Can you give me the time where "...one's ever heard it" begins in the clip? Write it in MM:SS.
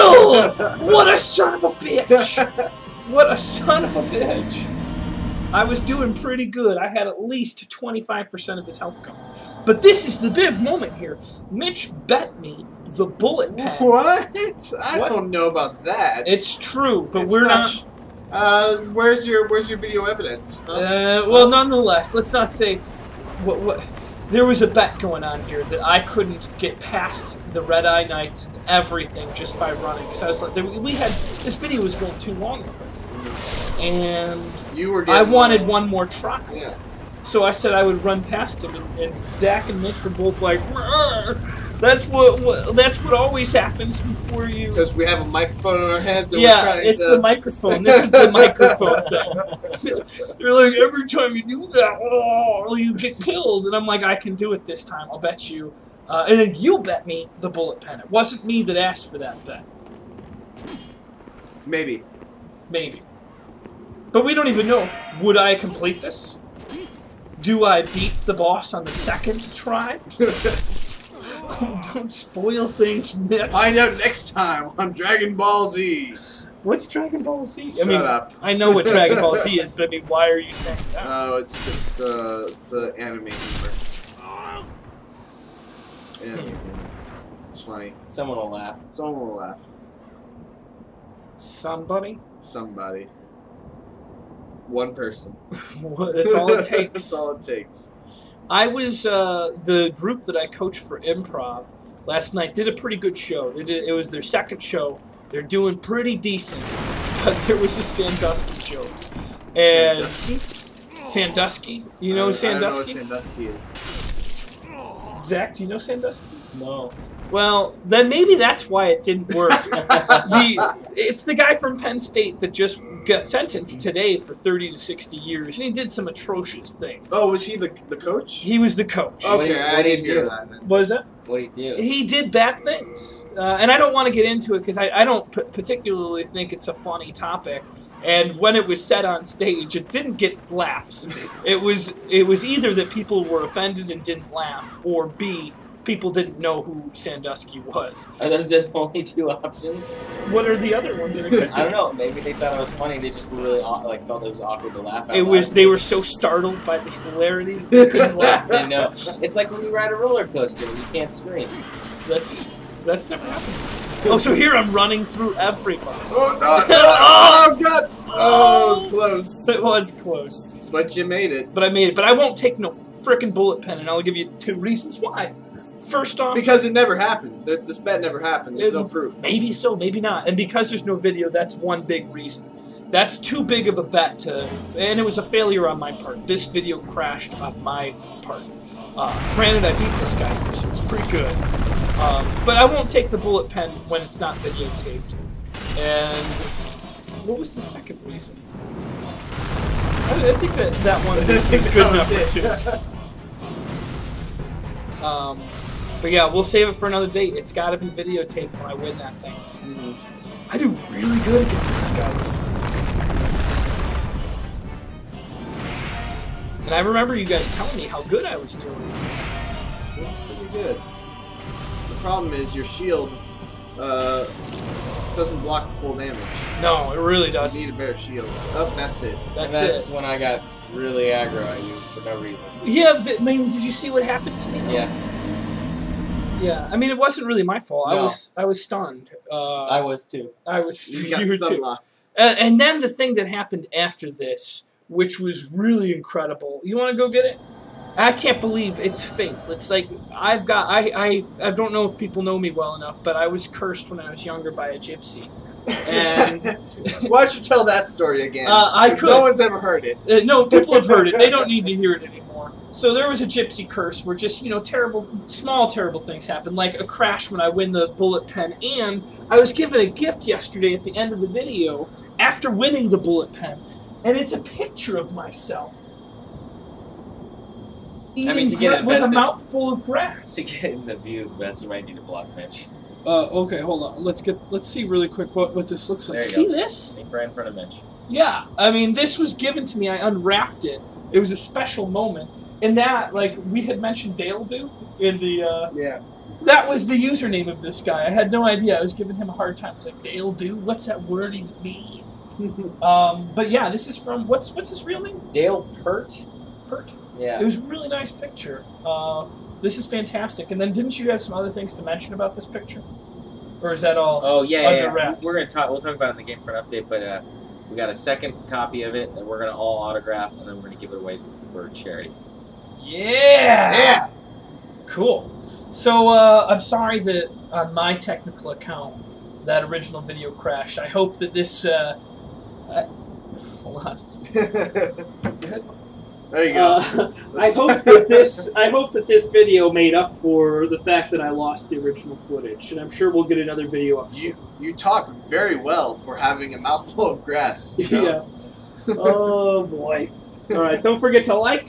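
04:19.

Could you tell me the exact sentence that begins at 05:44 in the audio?
You you talk very well for having a mouthful of grass.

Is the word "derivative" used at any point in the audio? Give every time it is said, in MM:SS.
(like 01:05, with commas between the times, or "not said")
not said.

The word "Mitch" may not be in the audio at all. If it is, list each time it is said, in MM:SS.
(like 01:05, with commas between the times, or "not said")
00:11, 00:39, 04:47.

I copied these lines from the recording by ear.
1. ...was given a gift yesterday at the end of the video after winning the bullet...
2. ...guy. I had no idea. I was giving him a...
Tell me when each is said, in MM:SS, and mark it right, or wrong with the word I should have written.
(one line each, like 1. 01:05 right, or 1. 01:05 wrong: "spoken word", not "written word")
1. 04:29 right
2. 04:57 right.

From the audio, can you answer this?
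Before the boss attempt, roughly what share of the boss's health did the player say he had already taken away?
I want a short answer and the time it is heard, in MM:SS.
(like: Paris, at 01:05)
25%, at 00:07.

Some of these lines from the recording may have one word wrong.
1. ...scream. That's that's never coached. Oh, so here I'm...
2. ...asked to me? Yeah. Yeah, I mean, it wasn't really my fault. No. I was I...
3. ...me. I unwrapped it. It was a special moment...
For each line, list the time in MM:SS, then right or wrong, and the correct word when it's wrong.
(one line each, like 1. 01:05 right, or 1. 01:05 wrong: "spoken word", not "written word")
1. 02:41 wrong: "happened", not "coached"
2. 03:54 wrong: "happened", not "asked"
3. 04:49 right.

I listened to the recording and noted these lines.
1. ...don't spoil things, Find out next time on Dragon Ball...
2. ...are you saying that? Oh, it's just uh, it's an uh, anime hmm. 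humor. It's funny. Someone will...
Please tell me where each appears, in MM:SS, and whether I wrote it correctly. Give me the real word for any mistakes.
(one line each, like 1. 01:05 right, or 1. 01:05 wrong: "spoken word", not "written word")
1. 01:11 right
2. 01:20 right.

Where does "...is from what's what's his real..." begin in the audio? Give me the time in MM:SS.
05:03.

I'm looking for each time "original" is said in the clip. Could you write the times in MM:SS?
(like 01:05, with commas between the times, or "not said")
05:29, 05:41.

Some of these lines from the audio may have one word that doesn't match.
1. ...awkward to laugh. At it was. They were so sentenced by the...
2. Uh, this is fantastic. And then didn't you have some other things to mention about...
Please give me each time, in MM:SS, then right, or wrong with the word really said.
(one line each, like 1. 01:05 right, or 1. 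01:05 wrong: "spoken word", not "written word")
1. 02:34 wrong: "startled", not "sentenced"
2. 05:08 right.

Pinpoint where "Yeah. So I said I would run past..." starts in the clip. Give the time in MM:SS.
00:36.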